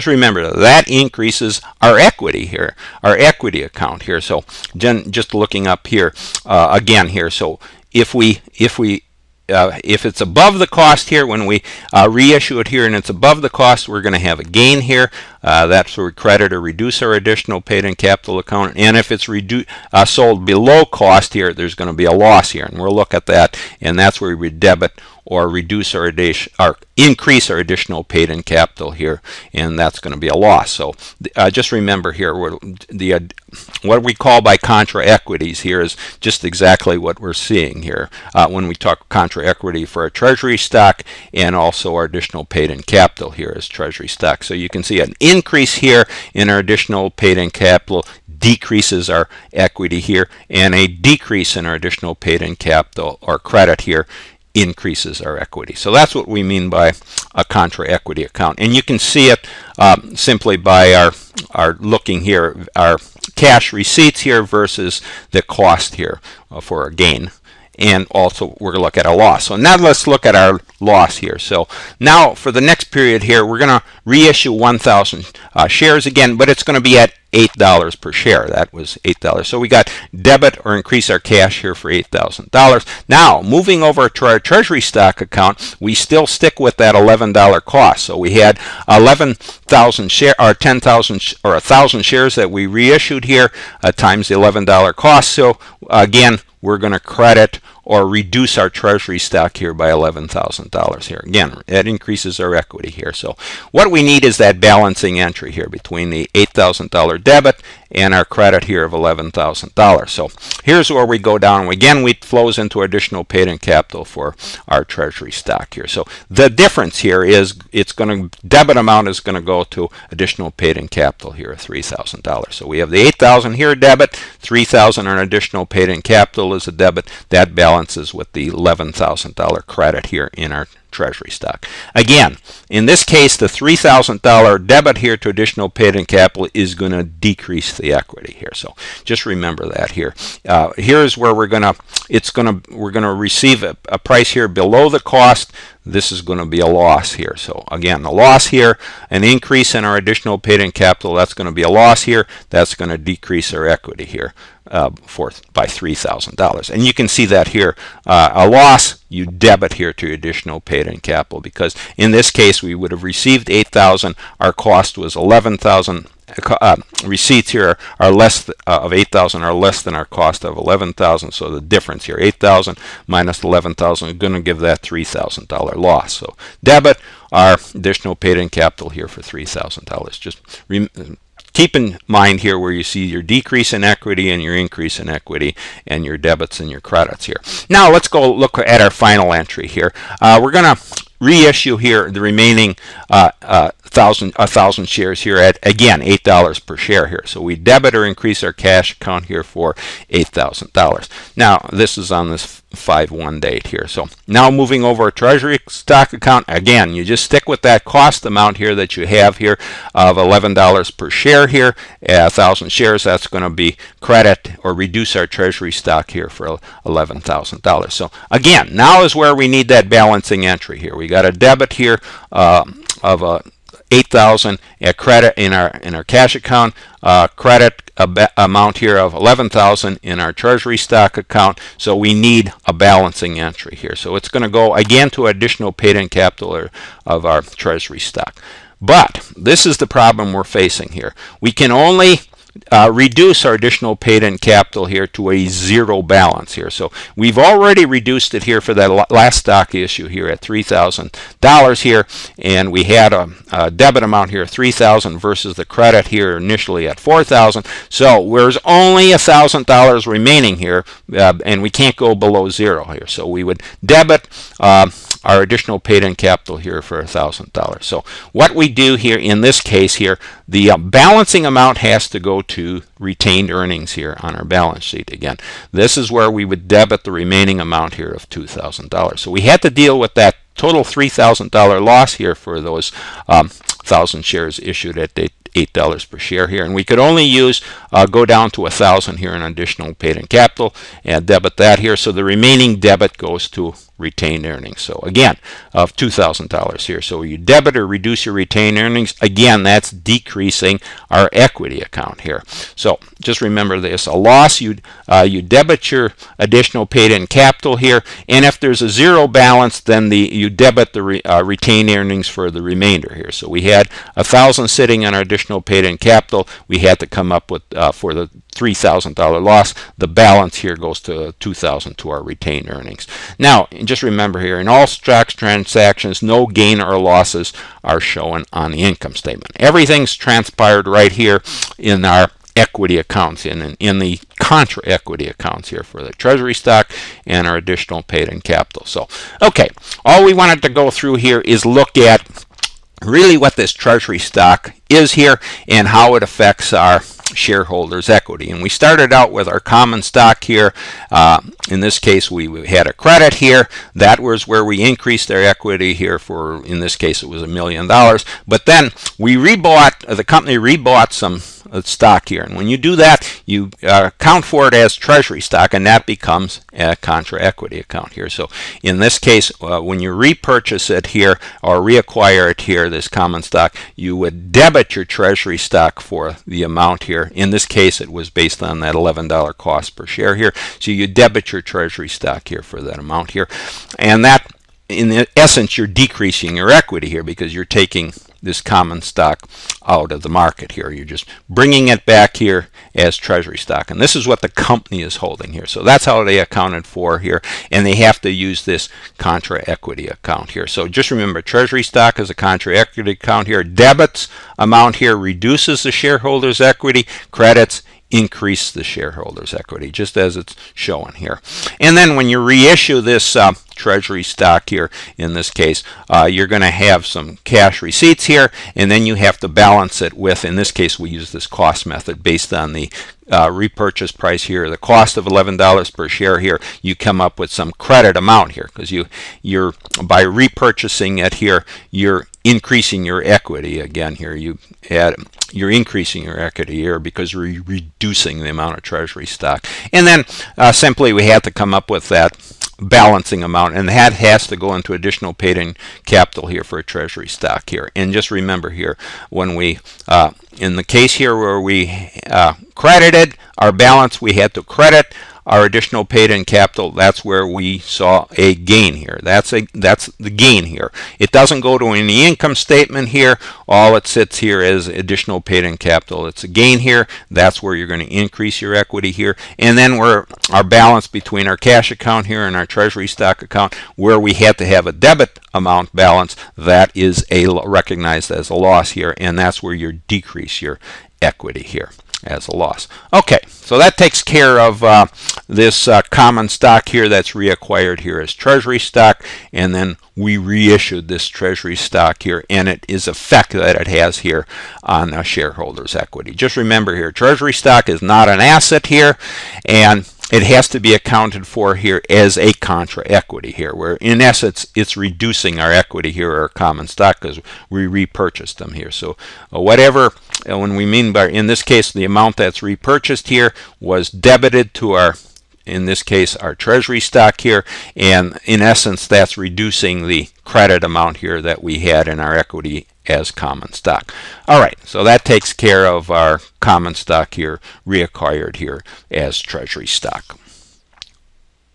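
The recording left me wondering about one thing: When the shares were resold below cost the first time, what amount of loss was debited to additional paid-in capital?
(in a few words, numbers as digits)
$3,000.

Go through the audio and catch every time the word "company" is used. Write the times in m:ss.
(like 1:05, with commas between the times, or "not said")
6:00, 6:34.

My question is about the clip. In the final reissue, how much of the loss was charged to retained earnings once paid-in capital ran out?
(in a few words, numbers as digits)
$2,000.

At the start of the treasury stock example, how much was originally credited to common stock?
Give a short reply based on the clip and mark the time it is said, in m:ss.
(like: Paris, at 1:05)
a million dollars, at 5:57.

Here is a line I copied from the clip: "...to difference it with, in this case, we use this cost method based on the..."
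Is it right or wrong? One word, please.
wrong.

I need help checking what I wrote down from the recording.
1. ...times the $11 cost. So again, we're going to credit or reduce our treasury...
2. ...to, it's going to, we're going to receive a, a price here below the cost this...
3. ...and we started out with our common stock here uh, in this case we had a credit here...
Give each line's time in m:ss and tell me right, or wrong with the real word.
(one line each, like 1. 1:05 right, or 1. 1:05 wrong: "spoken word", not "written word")
1. 1:33 right
2. 2:21 right
3. 5:48 right.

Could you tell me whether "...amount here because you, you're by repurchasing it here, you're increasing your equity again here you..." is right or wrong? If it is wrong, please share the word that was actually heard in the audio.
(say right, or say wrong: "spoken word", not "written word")
right.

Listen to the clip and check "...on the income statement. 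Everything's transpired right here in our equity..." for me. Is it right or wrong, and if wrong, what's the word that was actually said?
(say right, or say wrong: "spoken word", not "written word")
right.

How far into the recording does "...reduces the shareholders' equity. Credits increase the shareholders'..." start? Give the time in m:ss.
6:45.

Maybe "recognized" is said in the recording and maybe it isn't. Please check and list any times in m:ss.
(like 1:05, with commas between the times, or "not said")
7:57.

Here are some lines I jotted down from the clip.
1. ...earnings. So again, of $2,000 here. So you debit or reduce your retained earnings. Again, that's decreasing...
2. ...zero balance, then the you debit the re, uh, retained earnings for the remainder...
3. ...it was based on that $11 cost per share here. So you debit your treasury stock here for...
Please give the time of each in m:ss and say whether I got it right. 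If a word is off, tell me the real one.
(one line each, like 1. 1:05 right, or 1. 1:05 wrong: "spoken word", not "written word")
1. 4:54 right
2. 5:08 right
3. 6:17 right.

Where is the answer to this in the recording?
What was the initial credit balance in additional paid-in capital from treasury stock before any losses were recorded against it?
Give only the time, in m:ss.
4:16.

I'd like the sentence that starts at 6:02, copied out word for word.
And when you do that, you uh, account for it as treasury stock, and that becomes a contra equity account here.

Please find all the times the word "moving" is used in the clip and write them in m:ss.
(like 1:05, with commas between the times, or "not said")
1:23, 3:24.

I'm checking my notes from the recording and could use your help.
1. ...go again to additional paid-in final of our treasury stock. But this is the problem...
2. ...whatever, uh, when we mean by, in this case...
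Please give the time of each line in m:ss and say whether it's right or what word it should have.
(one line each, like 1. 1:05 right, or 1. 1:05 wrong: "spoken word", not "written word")
1. 3:54 wrong: "capital", not "final"
2. 8:29 right.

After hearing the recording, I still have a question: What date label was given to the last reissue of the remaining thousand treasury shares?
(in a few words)
5/1.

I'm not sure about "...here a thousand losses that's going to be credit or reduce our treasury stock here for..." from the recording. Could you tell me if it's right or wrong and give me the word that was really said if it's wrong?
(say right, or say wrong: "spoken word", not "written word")
wrong: "shares", not "losses".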